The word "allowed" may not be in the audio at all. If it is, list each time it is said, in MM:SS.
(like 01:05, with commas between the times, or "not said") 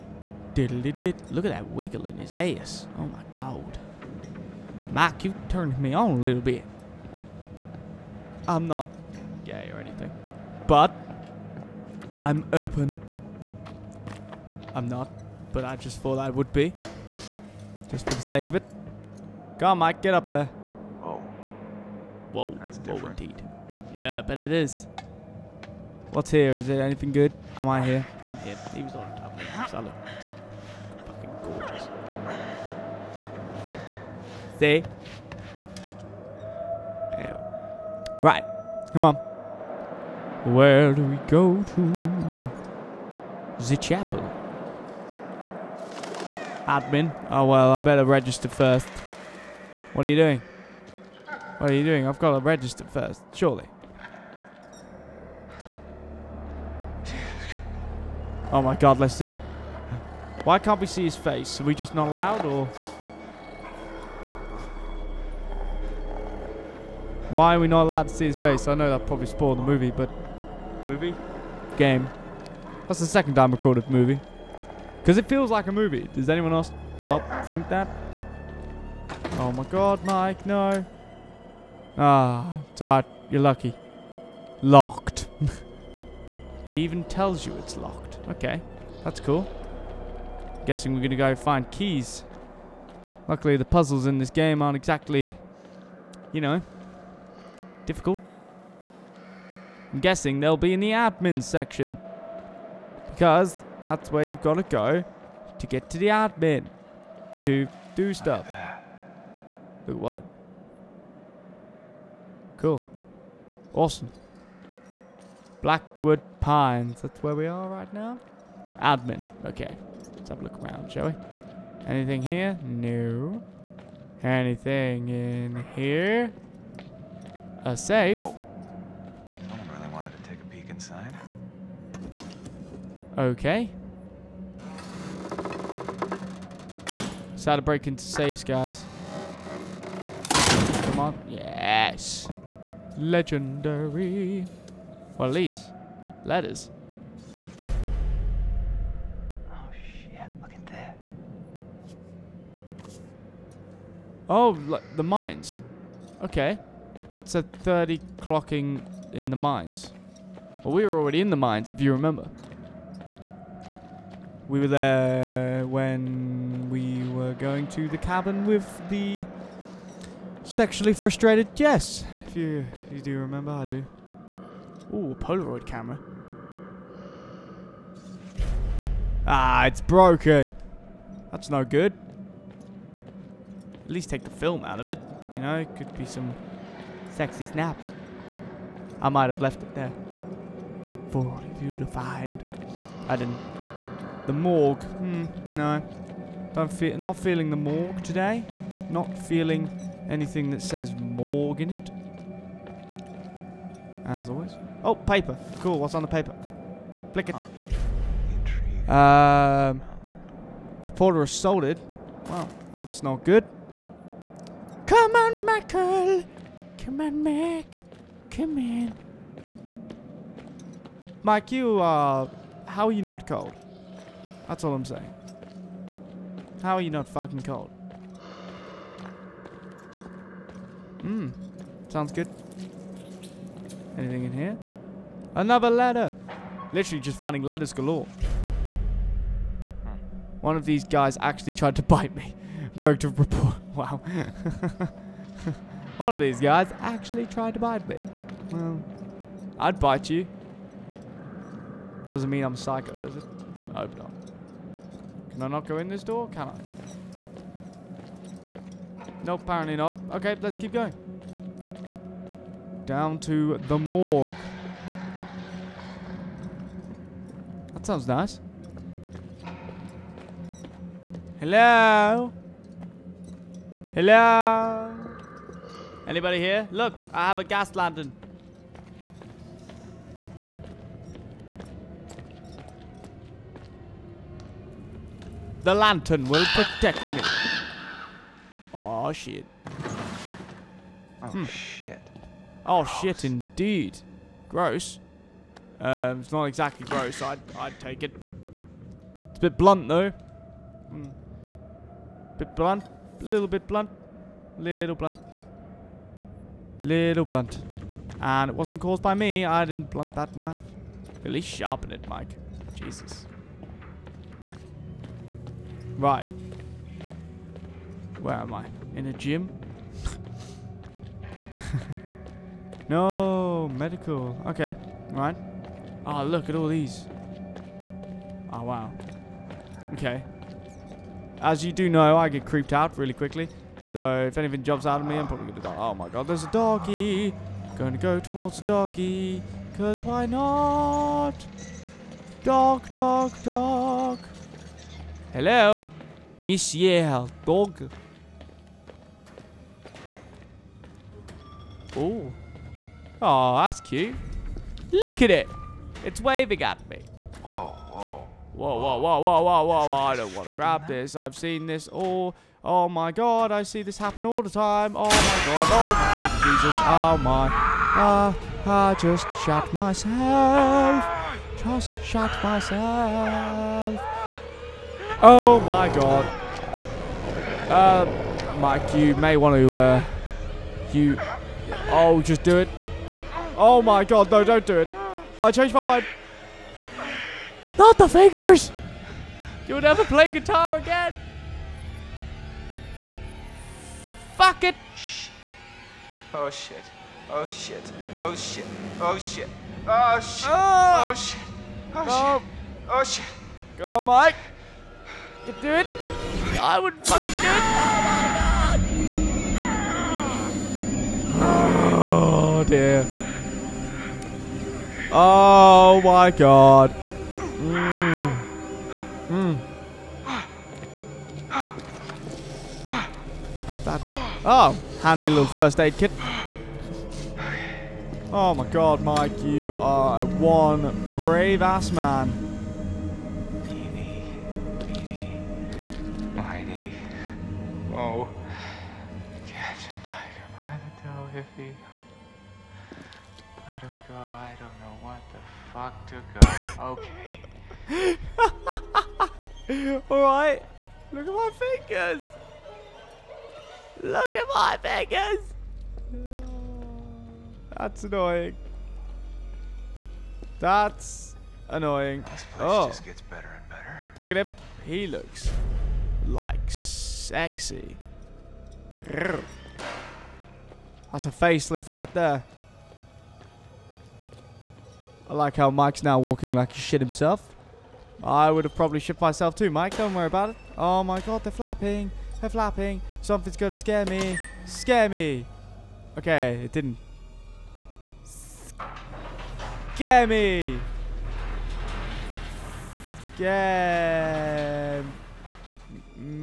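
01:02, 01:07.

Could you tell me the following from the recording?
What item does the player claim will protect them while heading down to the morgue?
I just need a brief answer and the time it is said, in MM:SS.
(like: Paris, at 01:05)
Gas lantern, at 04:37.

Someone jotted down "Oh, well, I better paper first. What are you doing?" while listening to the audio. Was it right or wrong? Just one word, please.
wrong.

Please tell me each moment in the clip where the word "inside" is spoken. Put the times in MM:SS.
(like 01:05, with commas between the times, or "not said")
02:10.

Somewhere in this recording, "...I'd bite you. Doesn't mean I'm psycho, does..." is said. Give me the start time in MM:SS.
04:09.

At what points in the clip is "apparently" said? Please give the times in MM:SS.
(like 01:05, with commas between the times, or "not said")
04:19.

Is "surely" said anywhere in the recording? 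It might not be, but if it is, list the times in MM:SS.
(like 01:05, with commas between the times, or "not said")
00:53.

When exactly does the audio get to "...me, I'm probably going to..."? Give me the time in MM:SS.
05:35.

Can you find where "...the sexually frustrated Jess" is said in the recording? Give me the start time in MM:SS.
02:48.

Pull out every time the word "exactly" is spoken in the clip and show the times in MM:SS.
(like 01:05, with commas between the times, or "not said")
01:34, 04:56.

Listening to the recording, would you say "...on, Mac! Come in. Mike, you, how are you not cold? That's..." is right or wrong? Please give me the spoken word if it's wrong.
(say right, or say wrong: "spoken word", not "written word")
right.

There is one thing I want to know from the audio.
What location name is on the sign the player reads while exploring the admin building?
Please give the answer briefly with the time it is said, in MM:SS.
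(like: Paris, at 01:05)
Blackwood Pines, at 01:55.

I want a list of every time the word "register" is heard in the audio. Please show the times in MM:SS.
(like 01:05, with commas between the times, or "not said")
00:48, 00:52.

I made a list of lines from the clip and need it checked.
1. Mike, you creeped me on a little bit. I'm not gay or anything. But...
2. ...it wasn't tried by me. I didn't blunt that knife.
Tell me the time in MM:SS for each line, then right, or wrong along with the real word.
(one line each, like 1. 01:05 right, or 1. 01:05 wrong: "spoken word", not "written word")
1. 00:04 wrong: "turned", not "creeped"
2. 05:08 wrong: "caused", not "tried".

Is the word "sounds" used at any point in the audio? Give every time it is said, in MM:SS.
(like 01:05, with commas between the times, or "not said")
03:51, 04:27.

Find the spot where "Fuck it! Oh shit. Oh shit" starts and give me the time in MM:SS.
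06:34.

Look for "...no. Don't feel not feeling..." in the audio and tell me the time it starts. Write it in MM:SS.
03:15.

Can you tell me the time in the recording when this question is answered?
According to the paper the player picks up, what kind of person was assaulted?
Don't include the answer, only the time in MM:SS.
03:30.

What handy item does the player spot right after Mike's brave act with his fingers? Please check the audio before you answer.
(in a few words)
First aid kit.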